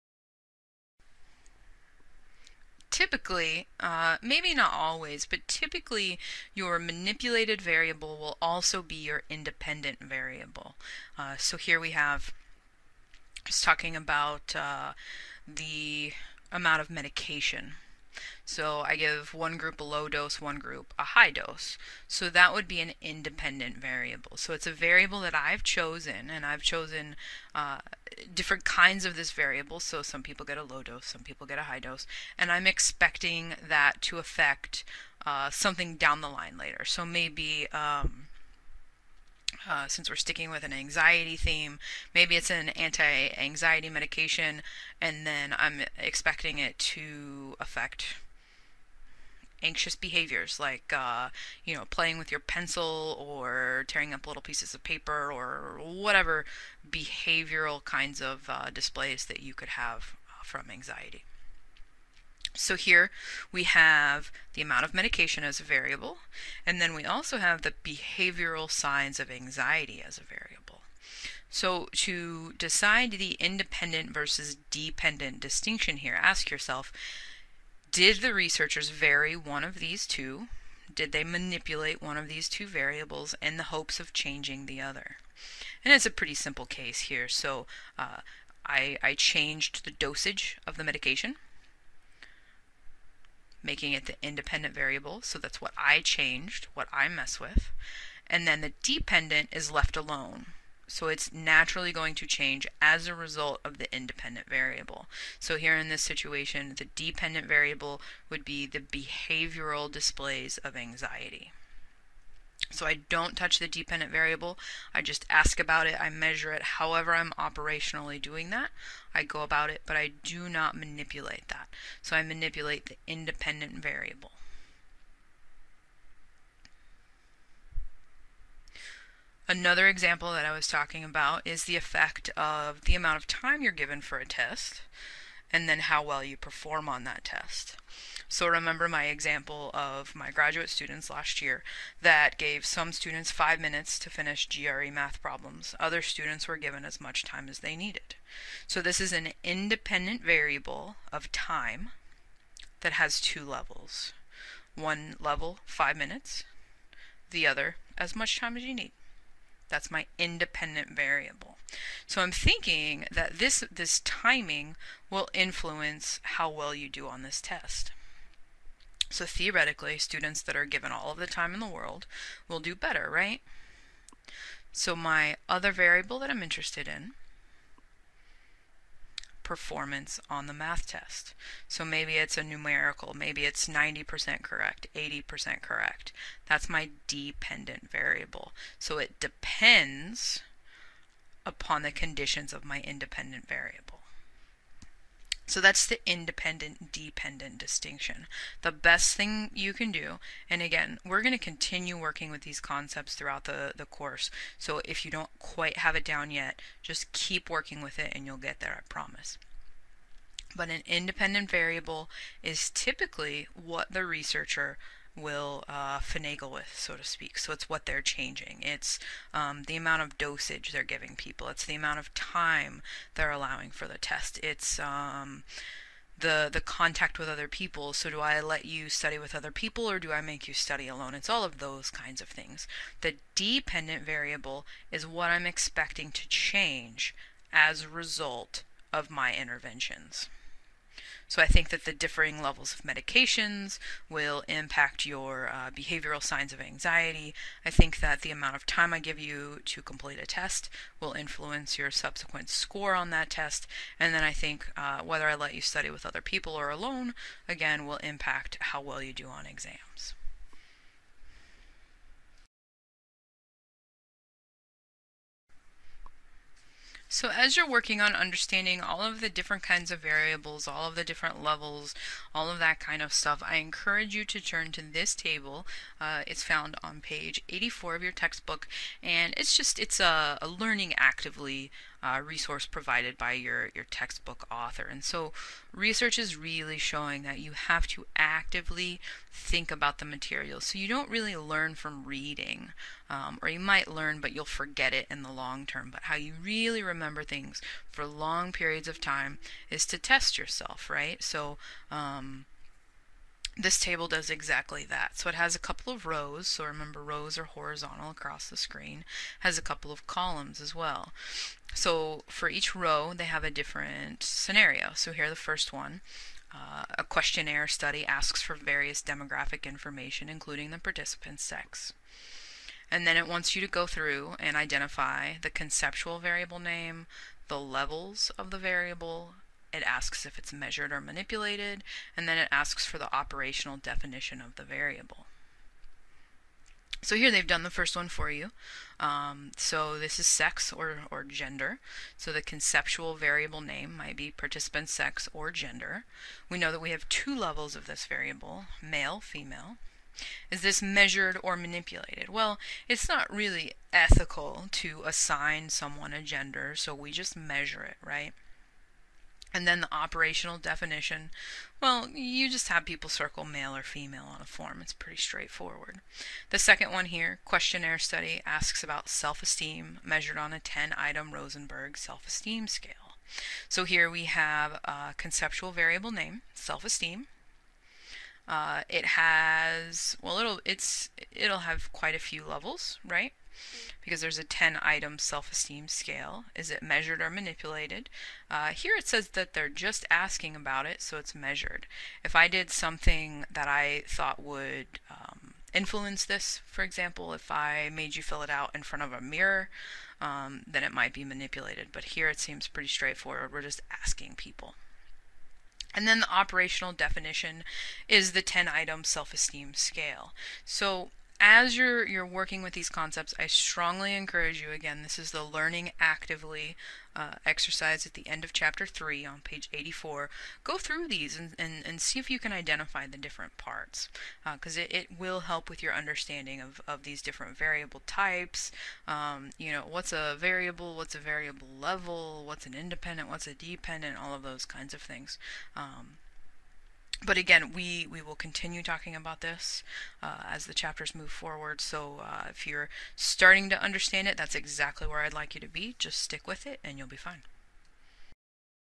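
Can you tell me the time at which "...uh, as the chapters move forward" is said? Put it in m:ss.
7:20.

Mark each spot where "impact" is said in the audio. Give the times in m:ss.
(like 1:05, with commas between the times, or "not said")
4:04, 4:17.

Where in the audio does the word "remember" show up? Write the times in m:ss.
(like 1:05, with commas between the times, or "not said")
2:18, 4:56, 5:06.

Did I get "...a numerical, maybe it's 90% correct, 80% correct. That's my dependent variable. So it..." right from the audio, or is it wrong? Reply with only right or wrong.
right.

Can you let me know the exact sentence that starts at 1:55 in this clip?
I measure it however I'm operationally doing that.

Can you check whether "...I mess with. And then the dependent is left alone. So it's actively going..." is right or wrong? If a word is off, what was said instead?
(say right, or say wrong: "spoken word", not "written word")
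wrong: "naturally", not "actively".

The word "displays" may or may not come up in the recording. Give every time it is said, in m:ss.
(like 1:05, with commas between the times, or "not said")
0:58, 1:49.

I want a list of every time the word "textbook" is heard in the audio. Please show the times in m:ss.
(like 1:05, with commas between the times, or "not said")
4:38, 4:43.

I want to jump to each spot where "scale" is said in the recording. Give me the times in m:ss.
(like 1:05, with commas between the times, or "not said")
6:12, 6:25, 6:49.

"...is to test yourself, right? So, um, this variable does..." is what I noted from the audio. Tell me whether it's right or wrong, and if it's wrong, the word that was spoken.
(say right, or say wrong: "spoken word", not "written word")
wrong: "table", not "variable".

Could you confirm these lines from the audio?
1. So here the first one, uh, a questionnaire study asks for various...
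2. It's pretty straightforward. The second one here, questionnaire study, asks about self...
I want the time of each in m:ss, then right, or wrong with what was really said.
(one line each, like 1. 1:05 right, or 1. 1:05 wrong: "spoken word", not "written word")
1. 5:14 right
2. 6:04 right.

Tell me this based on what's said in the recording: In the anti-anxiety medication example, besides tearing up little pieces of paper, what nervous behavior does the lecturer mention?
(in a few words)
Playing with your pencil.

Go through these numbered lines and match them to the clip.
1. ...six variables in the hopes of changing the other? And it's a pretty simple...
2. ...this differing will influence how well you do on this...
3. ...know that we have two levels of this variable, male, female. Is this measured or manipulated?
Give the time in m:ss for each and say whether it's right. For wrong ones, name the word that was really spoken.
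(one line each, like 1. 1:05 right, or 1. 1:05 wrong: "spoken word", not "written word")
1. 1:22 wrong: "two", not "six"
2. 2:43 wrong: "timing", not "differing"
3. 5:46 right.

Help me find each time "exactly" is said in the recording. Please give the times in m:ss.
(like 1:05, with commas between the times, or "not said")
5:04, 7:24.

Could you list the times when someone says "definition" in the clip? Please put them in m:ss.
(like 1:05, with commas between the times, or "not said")
5:33, 6:00, 6:46.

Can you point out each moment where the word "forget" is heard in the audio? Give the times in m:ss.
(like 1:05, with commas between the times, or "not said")
4:54.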